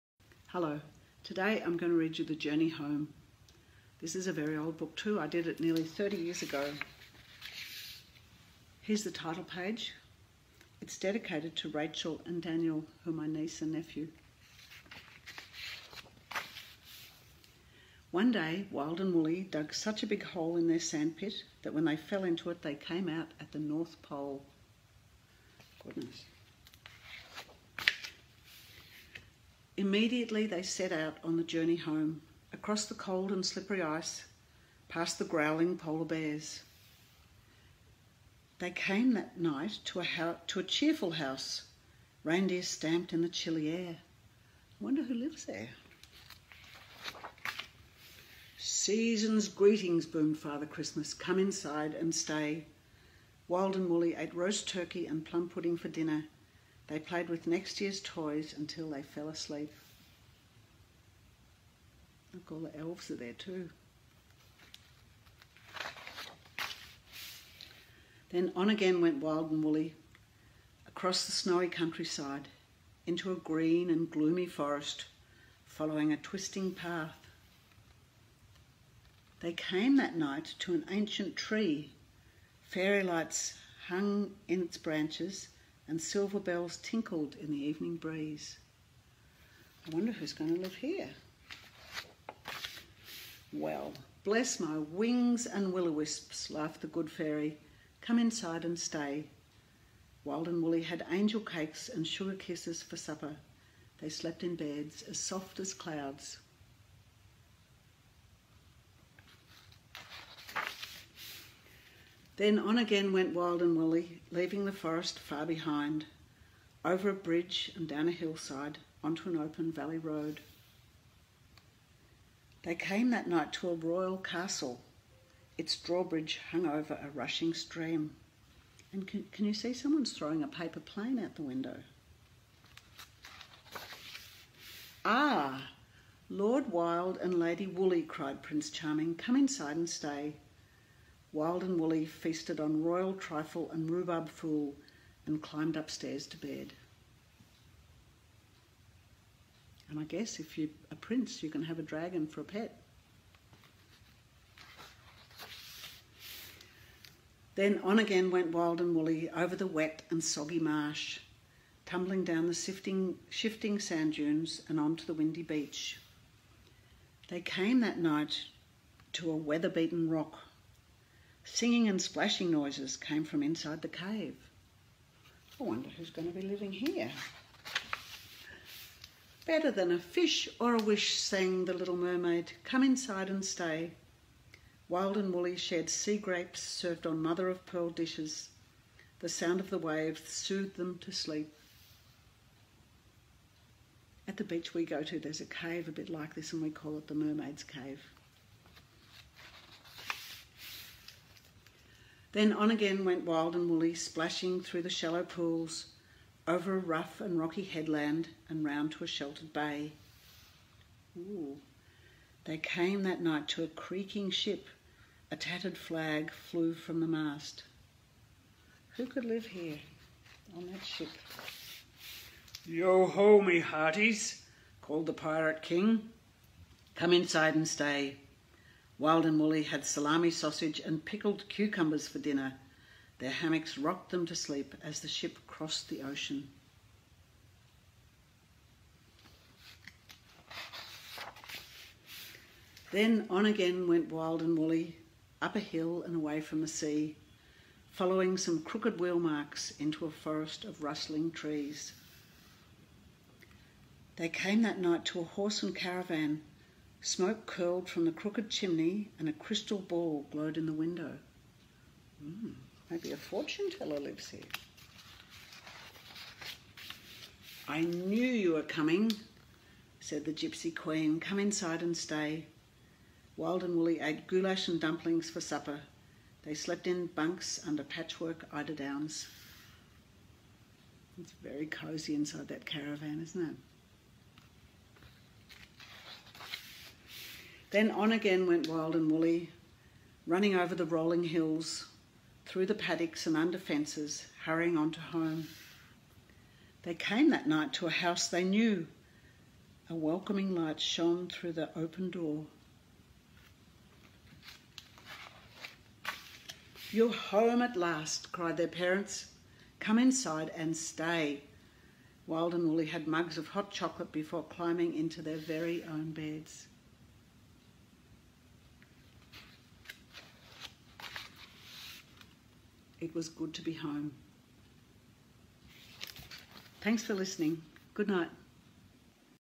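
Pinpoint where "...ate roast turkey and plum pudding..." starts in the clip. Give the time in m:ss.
0:54.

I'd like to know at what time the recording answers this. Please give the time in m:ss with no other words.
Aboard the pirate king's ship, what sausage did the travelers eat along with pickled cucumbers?
3:49.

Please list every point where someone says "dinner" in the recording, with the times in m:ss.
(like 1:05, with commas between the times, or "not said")
0:55, 3:52.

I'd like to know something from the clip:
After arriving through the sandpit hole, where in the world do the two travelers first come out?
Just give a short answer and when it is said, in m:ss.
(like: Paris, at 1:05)
The North Pole, at 0:23.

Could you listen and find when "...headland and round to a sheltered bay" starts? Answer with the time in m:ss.
3:27.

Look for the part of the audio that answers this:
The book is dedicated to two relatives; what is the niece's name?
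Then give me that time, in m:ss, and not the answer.
0:11.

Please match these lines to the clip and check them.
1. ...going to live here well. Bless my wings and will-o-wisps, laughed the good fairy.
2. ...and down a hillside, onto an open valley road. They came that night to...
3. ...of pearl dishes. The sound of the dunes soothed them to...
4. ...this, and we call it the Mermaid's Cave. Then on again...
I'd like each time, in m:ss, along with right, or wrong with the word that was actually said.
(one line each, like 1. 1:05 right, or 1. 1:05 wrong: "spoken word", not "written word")
1. 1:30 right
2. 1:57 right
3. 3:07 wrong: "waves", not "dunes"
4. 3:16 right.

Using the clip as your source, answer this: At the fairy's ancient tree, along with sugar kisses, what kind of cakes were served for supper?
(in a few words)
Angel cakes.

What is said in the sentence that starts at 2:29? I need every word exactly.
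And I guess if you're a prince, you can have a dragon for a pet.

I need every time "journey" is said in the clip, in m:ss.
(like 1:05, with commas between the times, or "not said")
0:02, 0:31.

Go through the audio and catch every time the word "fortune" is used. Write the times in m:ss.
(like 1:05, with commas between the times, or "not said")
4:23.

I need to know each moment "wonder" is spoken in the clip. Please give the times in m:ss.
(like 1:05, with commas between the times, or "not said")
0:44, 1:29, 2:55.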